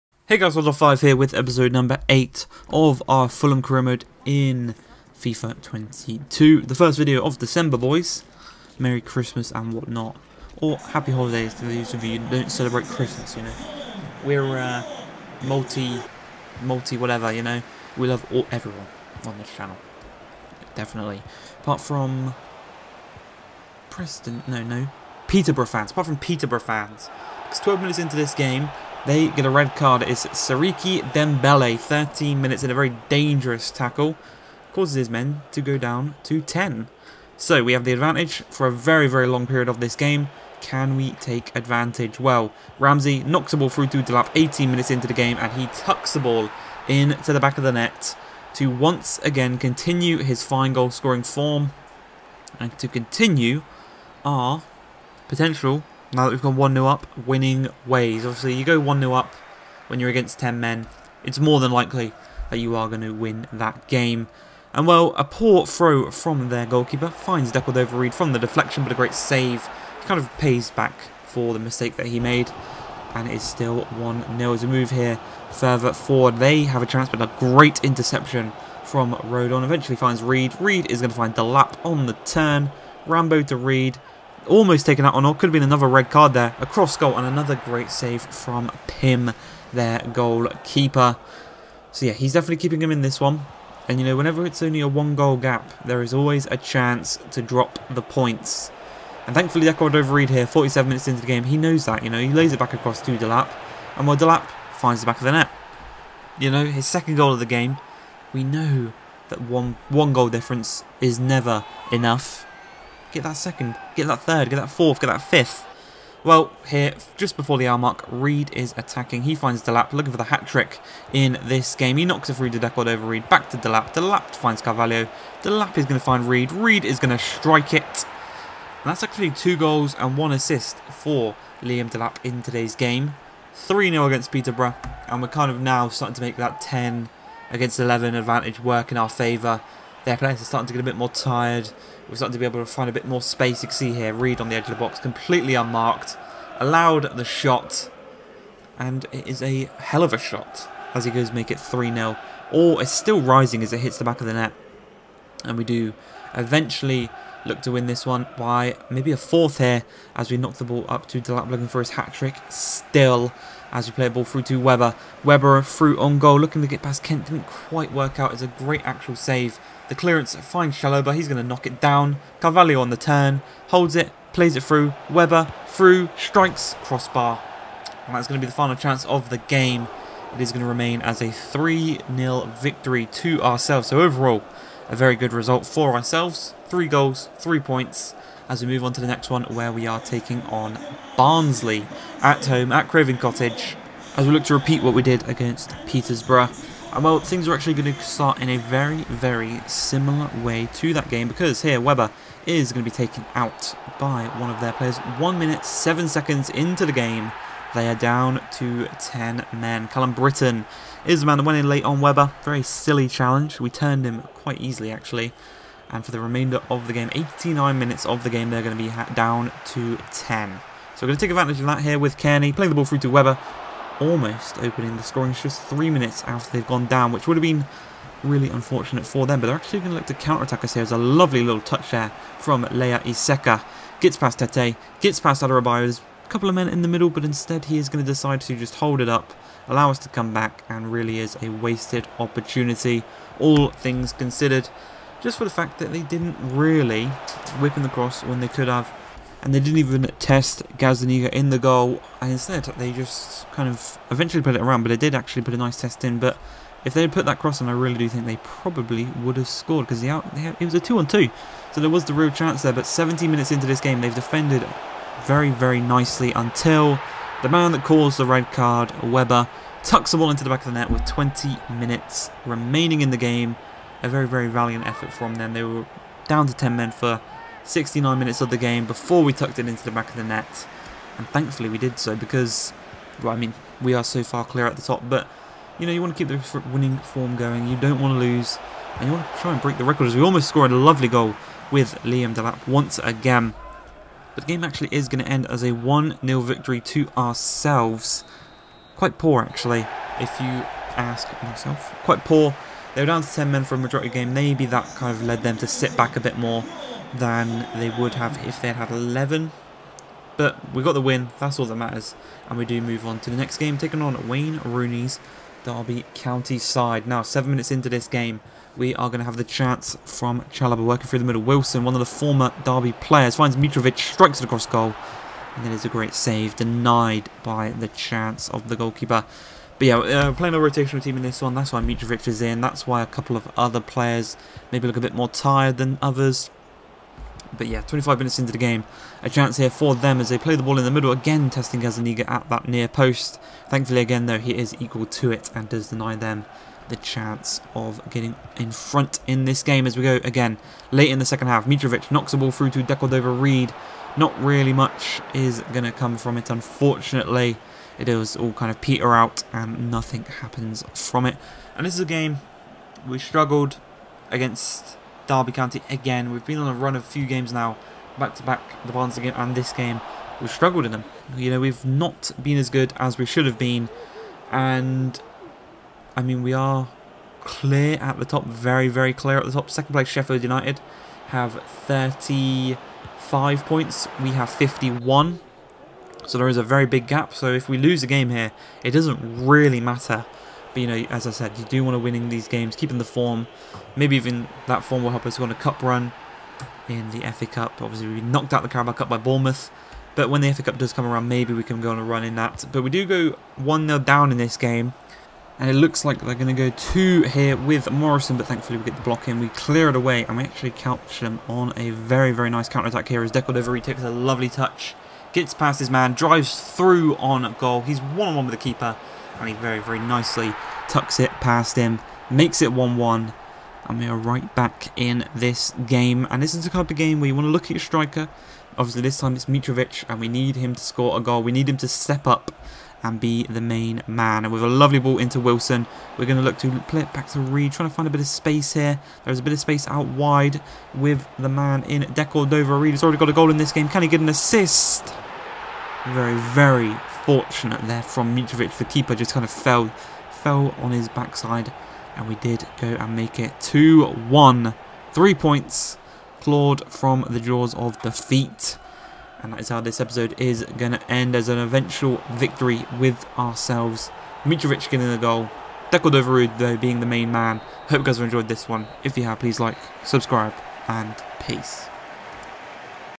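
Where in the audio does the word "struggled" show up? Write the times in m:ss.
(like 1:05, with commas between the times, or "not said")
6:03, 6:10.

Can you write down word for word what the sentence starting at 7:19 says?
There's a bit of space out wide with the man in Decordova.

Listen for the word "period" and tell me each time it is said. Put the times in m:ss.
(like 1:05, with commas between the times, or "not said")
0:39.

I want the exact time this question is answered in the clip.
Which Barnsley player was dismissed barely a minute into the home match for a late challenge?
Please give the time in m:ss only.
3:29.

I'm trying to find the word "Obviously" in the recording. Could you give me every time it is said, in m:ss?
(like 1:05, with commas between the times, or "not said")
0:58, 6:37, 7:08.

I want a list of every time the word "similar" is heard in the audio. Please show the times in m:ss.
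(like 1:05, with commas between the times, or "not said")
3:19.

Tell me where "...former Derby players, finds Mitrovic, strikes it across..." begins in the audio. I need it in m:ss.
5:22.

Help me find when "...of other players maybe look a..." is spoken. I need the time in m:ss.
5:33.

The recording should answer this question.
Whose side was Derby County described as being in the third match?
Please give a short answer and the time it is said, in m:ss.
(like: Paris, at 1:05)
Wayne Rooney, at 5:14.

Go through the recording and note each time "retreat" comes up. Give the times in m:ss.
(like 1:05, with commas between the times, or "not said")
not said.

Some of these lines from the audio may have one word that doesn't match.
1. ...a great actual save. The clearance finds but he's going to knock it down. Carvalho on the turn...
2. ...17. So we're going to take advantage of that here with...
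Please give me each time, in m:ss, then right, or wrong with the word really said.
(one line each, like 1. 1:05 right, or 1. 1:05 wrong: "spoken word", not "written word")
1. 2:48 right
2. 3:40 wrong: "10", not "17".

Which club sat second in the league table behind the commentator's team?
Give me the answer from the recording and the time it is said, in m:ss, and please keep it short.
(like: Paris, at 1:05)
Sheffield United, at 6:20.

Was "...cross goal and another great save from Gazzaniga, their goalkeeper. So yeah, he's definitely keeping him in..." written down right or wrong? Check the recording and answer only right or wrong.
wrong.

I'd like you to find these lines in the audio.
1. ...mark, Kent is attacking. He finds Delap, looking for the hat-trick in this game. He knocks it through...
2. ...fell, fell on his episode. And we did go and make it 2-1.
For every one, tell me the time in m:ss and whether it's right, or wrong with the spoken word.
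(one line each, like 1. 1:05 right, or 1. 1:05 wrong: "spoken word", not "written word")
1. 1:57 wrong: "Reed", not "Kent"
2. 7:29 wrong: "backside", not "episode".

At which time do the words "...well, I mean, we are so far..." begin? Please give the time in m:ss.
4:43.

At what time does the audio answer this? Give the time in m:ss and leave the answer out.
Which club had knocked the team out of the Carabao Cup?
6:39.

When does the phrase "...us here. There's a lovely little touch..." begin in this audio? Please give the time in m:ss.
3:50.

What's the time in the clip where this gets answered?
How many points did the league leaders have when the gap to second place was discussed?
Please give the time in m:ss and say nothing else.
6:24.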